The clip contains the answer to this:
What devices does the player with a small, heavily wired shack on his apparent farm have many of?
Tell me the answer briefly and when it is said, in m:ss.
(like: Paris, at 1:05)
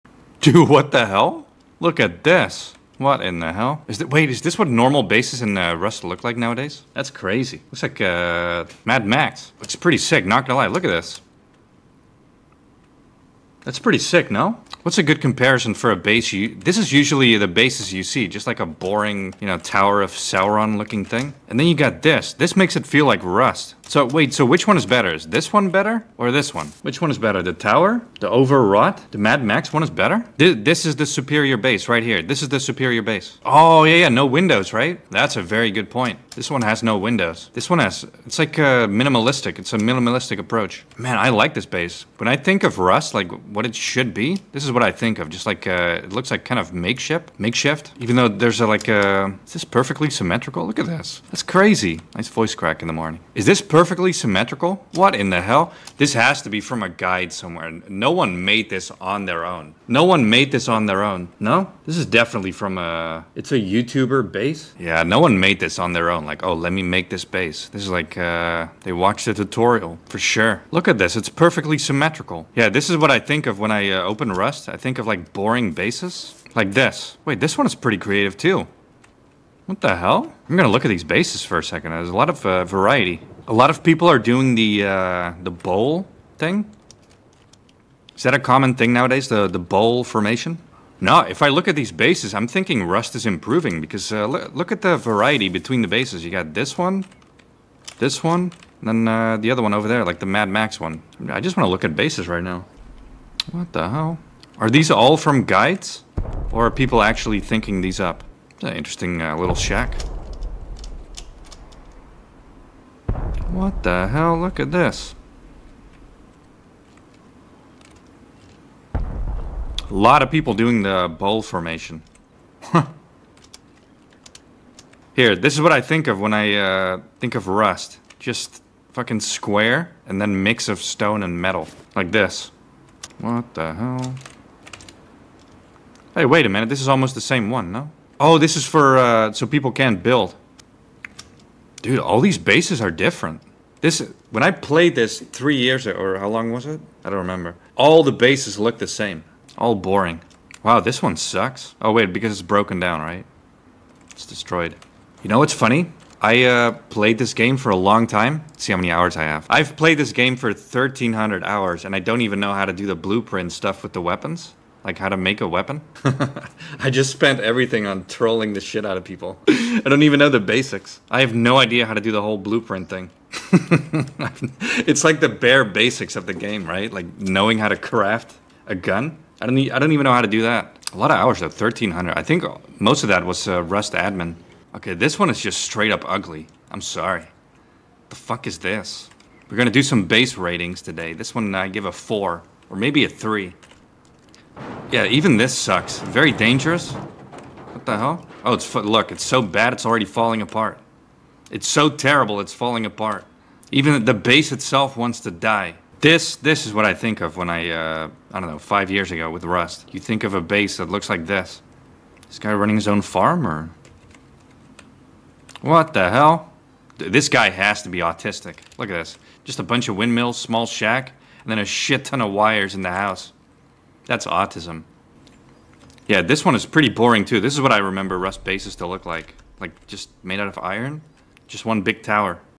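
Windmills, at 3:39.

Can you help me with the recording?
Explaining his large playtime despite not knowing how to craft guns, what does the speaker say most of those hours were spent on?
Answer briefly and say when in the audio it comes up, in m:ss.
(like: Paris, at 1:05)
Rust admin, at 3:03.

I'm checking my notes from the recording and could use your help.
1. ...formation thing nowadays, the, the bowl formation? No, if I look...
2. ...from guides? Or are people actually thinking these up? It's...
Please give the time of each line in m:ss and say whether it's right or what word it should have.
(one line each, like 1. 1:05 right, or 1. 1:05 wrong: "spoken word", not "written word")
1. 1:28 wrong: "common", not "formation"
2. 1:45 right.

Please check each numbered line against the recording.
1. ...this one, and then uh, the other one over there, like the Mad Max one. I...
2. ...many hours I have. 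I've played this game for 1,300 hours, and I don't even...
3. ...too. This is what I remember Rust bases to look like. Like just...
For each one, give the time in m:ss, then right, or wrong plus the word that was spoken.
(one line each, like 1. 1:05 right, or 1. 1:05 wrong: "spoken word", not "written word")
1. 1:37 right
2. 2:38 right
3. 3:47 right.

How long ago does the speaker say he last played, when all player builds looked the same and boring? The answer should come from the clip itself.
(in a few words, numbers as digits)
3 years ago.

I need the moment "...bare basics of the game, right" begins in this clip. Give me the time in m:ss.
2:55.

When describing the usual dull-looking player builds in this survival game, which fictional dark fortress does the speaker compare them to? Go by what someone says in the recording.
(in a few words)
Tower of Sauron.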